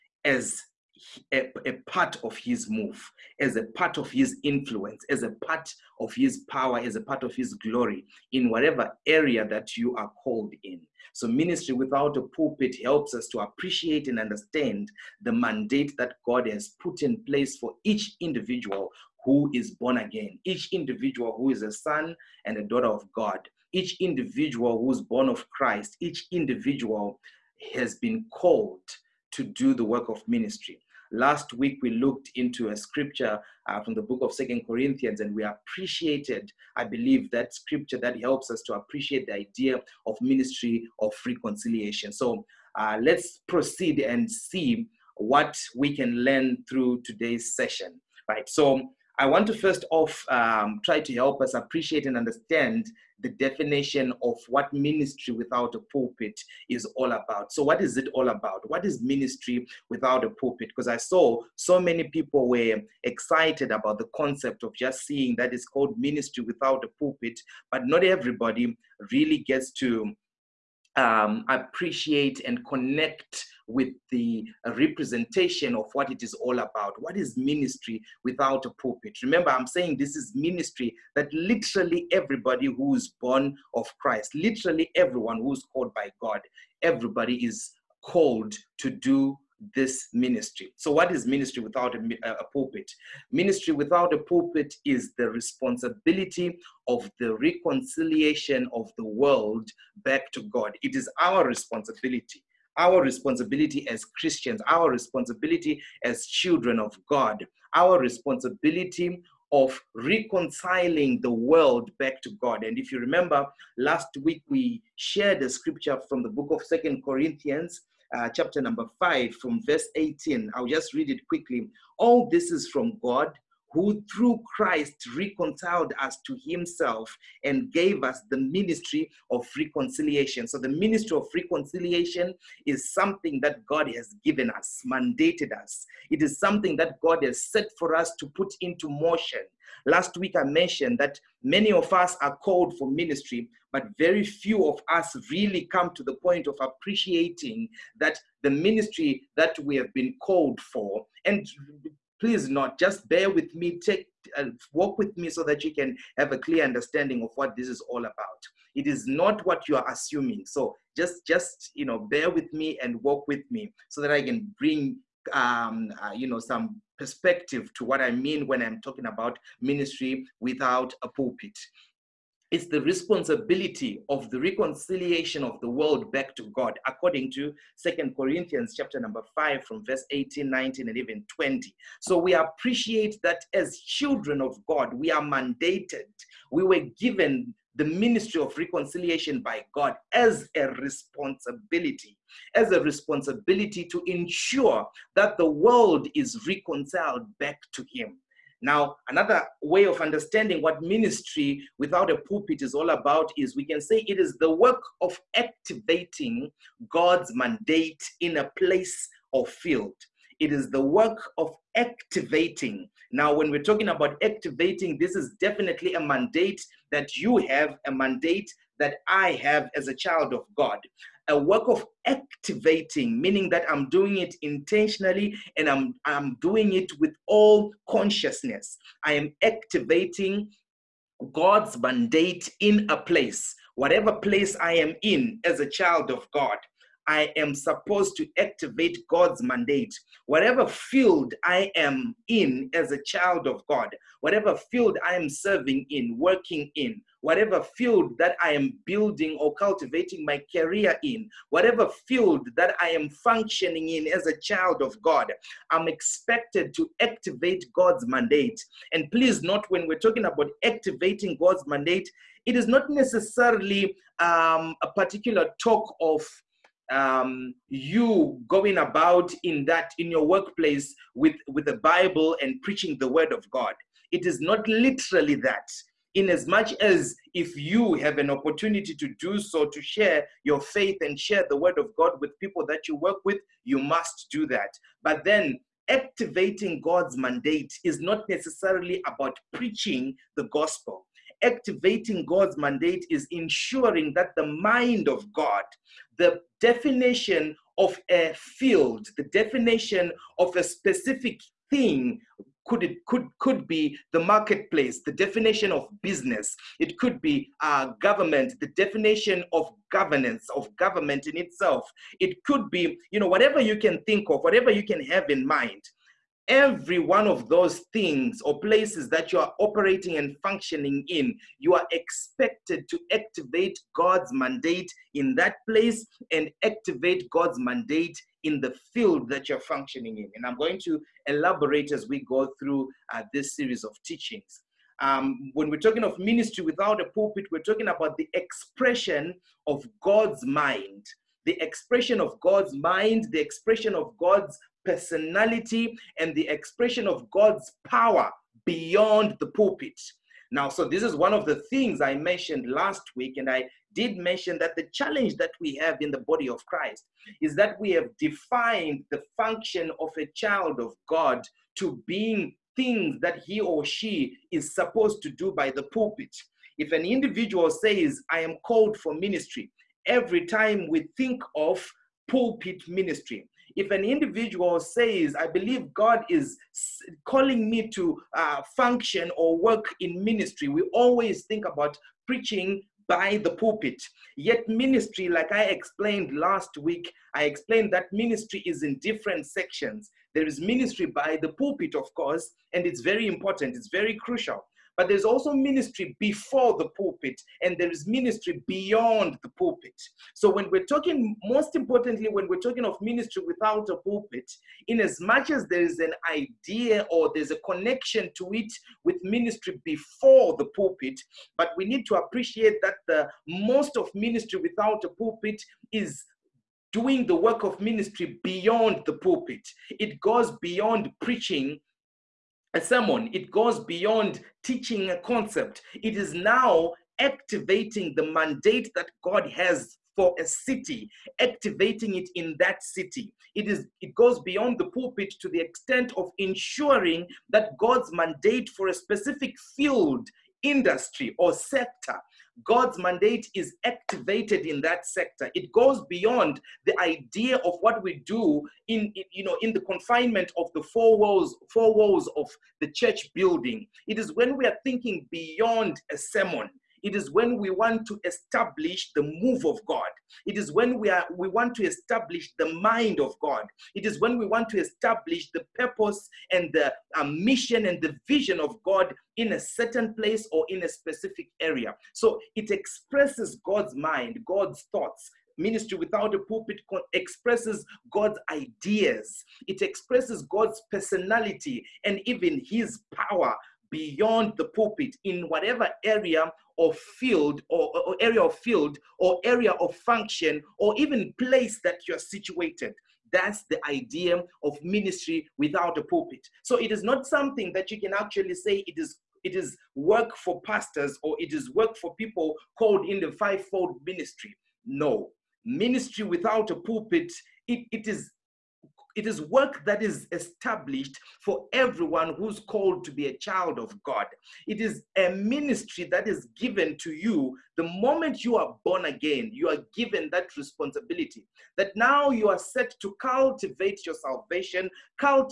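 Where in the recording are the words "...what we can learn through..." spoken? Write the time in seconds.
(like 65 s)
45 s.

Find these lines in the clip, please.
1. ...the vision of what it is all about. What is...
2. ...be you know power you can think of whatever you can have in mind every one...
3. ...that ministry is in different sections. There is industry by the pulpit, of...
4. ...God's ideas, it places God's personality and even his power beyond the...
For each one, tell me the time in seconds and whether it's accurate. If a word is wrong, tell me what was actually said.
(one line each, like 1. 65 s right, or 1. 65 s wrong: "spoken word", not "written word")
1. 74 s wrong: "representation", not "vision"
2. 312 s wrong: "whatever", not "power"
3. 387 s wrong: "ministry", not "industry"
4. 478 s wrong: "expresses", not "places".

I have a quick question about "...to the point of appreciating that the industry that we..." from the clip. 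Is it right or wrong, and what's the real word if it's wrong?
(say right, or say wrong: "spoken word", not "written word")
wrong: "ministry", not "industry".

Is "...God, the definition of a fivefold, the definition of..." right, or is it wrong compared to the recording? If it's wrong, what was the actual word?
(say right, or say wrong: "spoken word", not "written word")
wrong: "field", not "fivefold".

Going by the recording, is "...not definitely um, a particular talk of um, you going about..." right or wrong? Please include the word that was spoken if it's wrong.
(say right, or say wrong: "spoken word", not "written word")
wrong: "necessarily", not "definitely".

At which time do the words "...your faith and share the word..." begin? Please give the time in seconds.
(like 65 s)
280 s.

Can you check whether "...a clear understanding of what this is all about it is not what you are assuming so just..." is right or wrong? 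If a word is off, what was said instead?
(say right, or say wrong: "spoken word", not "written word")
right.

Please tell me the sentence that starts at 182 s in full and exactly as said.
So we appreciate that as children of God, we are mandated.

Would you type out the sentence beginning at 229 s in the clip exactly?
I am activating God's mandate in a place, whatever place I am in as a child of God.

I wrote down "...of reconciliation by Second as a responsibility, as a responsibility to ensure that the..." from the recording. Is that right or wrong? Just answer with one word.
wrong.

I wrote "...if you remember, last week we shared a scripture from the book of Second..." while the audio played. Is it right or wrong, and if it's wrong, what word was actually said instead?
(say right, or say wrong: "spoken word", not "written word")
right.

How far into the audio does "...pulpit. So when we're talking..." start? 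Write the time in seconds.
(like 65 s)
399 s.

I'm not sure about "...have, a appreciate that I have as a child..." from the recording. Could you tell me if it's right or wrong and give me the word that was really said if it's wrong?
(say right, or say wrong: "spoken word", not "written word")
wrong: "mandate", not "appreciate".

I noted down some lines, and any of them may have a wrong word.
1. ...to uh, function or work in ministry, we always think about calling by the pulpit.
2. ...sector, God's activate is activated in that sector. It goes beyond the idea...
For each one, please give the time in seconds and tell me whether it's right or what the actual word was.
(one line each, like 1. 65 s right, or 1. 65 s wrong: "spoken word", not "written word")
1. 377 s wrong: "preaching", not "calling"
2. 441 s wrong: "mandate", not "activate".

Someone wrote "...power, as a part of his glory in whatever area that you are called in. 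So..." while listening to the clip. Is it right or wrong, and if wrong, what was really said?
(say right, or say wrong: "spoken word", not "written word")
right.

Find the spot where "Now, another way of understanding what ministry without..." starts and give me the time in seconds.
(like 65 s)
198 s.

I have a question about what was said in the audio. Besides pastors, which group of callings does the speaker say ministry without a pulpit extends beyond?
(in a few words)
fivefold ministry.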